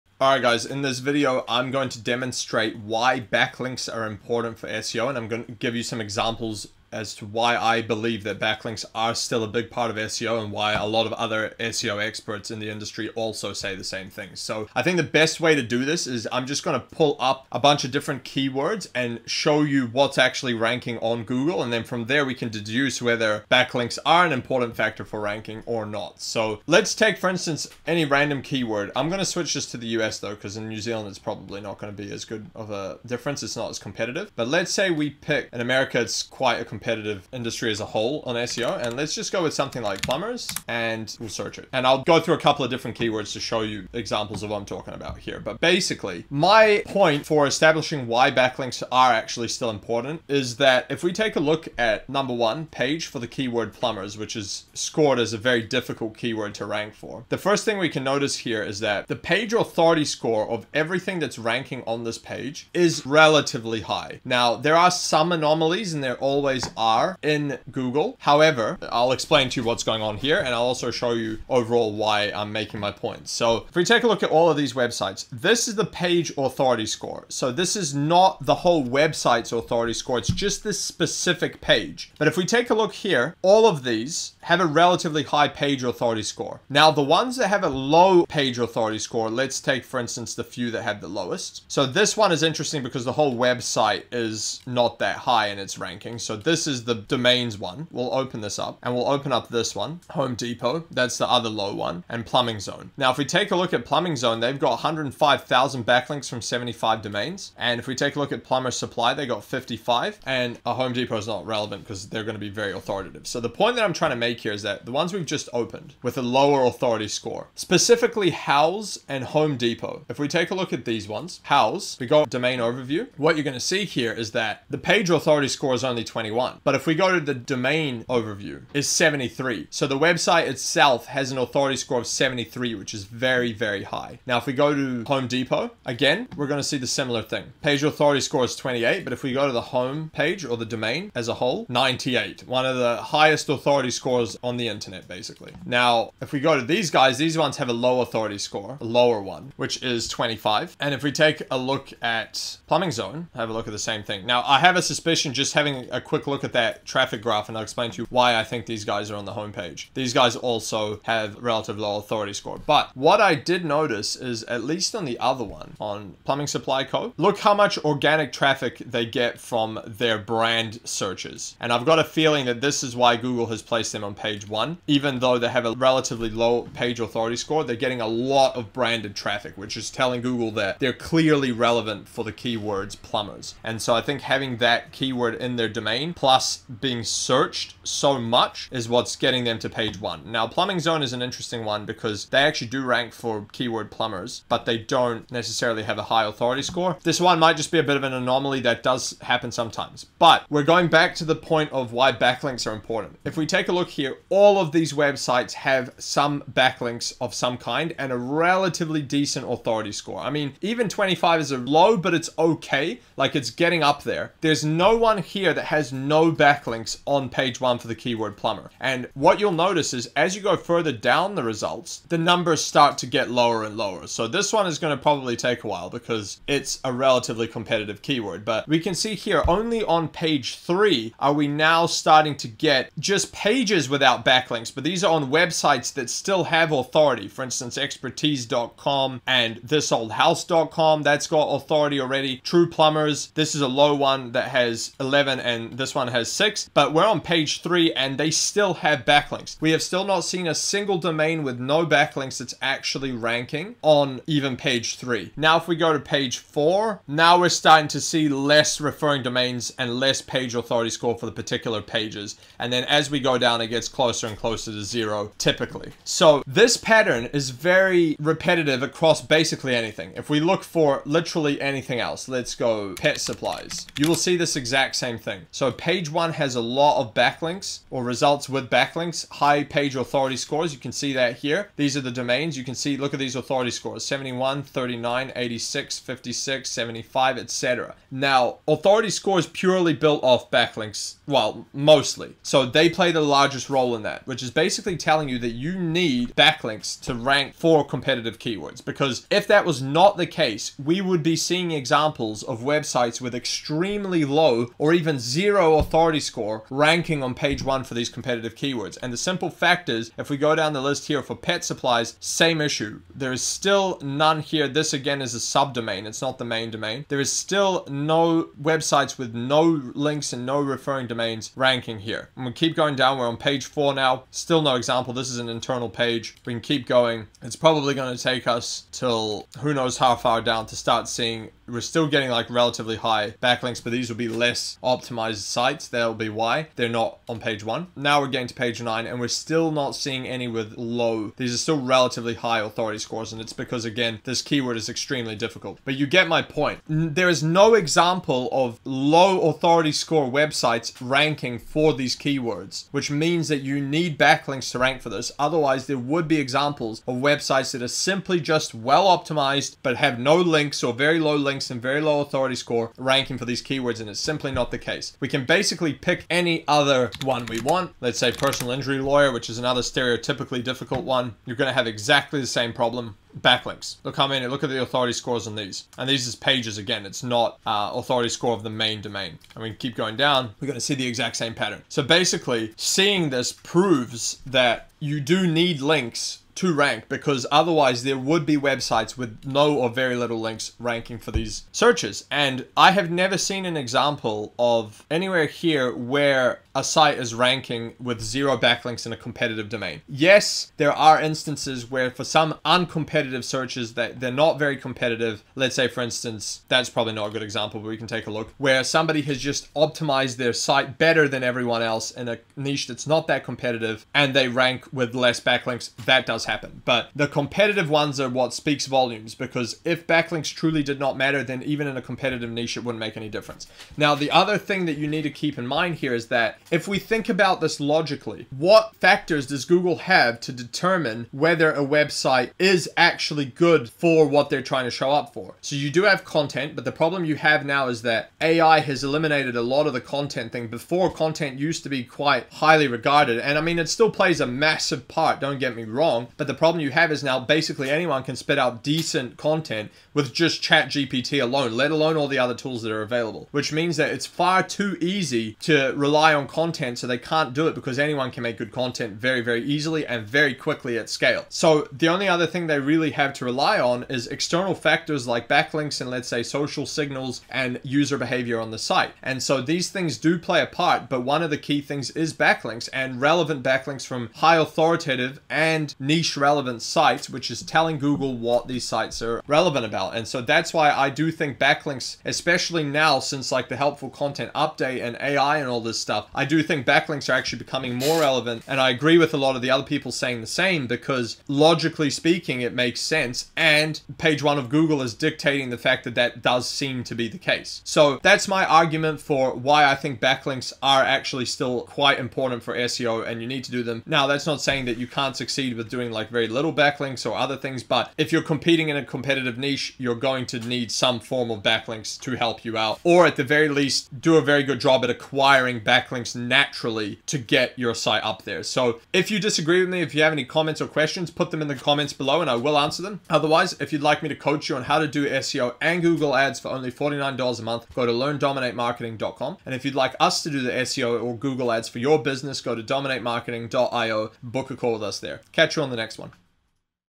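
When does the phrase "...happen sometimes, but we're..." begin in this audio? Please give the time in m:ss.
3:19.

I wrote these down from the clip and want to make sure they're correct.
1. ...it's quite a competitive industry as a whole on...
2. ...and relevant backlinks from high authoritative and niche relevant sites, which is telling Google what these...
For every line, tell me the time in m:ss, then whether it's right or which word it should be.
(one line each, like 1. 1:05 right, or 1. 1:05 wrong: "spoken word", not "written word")
1. 0:36 right
2. 7:52 right.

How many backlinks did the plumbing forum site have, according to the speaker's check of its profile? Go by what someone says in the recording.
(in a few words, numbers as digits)
105,000.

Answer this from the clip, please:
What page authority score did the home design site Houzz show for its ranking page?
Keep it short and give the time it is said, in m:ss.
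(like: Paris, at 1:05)
21, at 2:06.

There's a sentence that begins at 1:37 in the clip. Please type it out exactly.
We'll open this up and we'll open up this one, Home Depot.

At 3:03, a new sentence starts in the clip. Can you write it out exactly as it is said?
And so I think having that keyword in their domain, plus being searched so much is what's getting them to page one.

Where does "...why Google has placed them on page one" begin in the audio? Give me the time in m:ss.
2:52.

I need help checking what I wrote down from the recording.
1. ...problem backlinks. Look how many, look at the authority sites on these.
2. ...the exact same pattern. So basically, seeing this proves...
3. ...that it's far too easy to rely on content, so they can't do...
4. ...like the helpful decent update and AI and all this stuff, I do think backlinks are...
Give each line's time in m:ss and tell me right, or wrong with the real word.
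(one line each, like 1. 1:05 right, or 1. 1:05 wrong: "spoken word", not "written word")
1. 6:12 wrong: "scores", not "sites"
2. 6:20 right
3. 7:33 right
4. 8:03 wrong: "content", not "decent".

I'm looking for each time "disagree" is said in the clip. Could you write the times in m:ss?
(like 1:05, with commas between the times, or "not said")
8:39.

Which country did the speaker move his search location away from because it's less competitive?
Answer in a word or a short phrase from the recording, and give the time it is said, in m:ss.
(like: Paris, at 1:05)
New Zealand, at 0:30.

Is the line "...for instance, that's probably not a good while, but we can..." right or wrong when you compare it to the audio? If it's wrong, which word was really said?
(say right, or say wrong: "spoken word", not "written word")
wrong: "example", not "while".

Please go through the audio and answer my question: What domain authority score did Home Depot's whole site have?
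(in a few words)
98.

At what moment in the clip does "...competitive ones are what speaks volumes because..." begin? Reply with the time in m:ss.
6:57.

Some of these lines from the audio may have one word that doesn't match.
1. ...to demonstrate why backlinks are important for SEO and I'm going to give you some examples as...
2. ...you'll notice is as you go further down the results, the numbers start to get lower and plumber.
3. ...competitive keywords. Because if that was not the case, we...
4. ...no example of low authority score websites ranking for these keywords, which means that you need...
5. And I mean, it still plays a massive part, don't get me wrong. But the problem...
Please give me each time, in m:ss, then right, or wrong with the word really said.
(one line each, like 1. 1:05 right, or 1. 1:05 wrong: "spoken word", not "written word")
1. 0:01 right
2. 3:39 wrong: "lower", not "plumber"
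3. 4:57 right
4. 5:47 right
5. 7:23 right.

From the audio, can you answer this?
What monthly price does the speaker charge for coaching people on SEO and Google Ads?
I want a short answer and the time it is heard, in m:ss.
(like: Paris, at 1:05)
$49, at 8:46.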